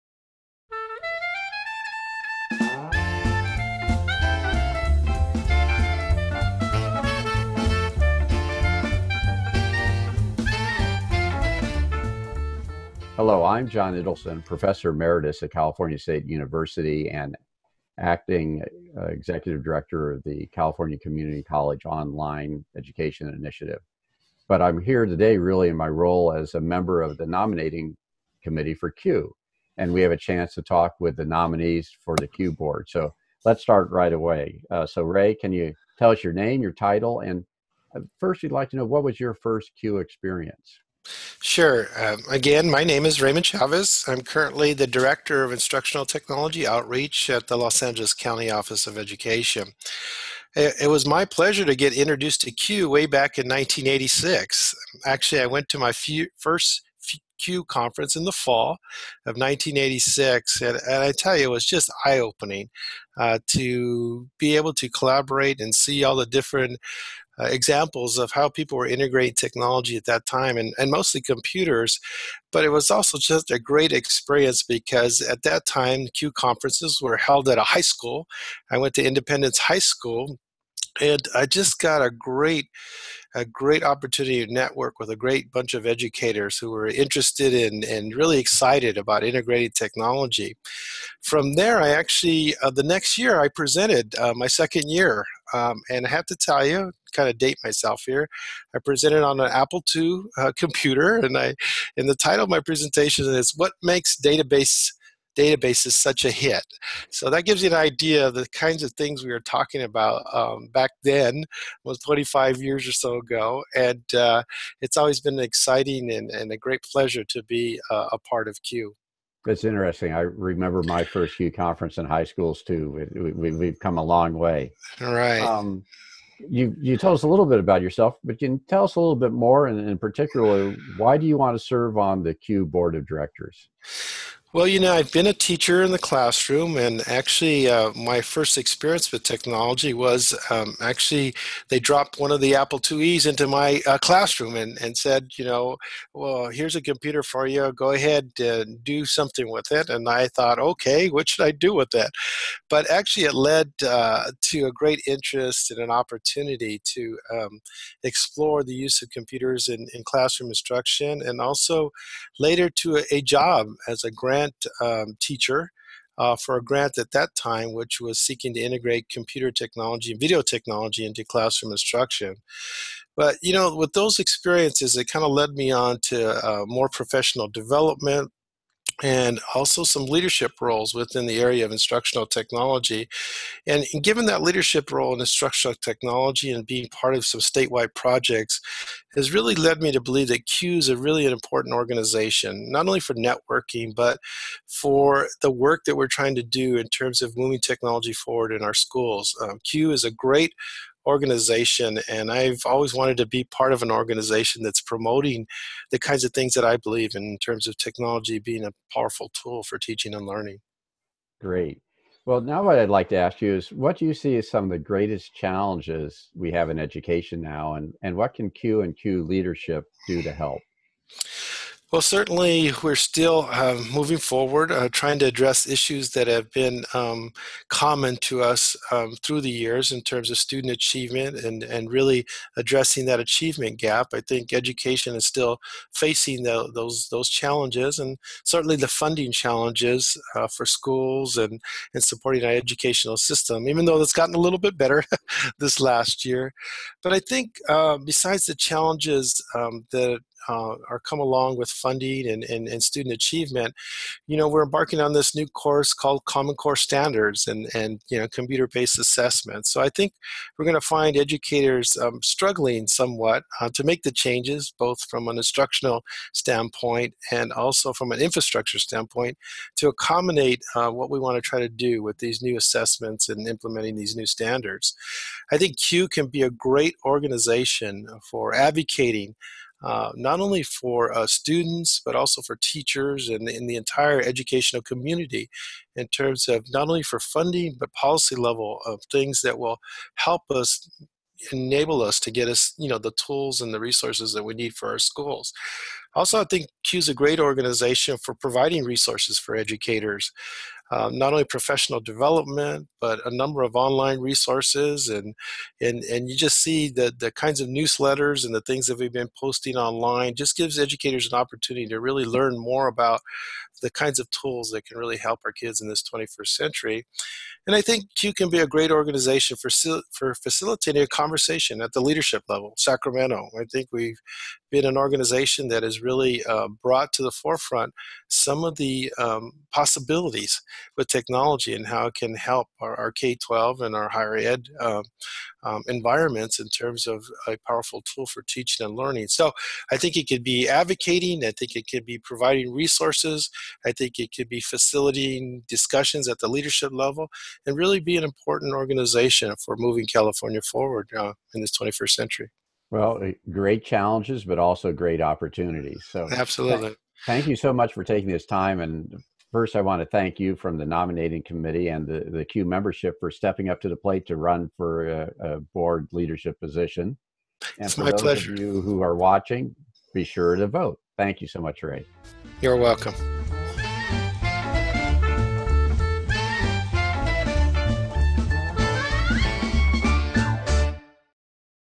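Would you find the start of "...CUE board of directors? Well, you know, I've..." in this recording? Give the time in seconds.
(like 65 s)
132 s.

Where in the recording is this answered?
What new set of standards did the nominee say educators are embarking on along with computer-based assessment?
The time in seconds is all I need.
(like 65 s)
256 s.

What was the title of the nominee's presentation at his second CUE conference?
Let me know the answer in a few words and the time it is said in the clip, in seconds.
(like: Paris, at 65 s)
What Makes Database, at 103 s.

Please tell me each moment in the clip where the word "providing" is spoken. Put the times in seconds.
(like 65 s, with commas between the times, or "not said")
298 s, 342 s.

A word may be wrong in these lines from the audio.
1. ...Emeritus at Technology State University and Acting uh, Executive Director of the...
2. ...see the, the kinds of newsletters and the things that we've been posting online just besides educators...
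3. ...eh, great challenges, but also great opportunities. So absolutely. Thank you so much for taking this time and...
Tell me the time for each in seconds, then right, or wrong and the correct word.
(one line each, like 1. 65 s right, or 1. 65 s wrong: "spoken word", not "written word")
1. 14 s wrong: "California", not "Technology"
2. 306 s wrong: "gives", not "besides"
3. 353 s right.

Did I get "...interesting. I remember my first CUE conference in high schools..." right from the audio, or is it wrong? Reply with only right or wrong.
right.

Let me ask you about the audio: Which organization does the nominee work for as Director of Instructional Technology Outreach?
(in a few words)
Los Angeles County Office of Education.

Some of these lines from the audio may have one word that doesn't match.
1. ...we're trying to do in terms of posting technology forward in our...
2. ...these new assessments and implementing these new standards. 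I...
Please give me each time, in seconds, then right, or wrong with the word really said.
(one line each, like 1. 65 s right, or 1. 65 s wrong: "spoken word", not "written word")
1. 195 s wrong: "moving", not "posting"
2. 272 s right.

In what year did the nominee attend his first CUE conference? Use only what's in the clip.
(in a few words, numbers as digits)
1986.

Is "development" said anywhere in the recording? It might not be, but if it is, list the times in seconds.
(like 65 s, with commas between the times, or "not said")
177 s, 302 s.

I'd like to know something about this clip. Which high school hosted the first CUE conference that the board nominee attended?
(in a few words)
Independence High School.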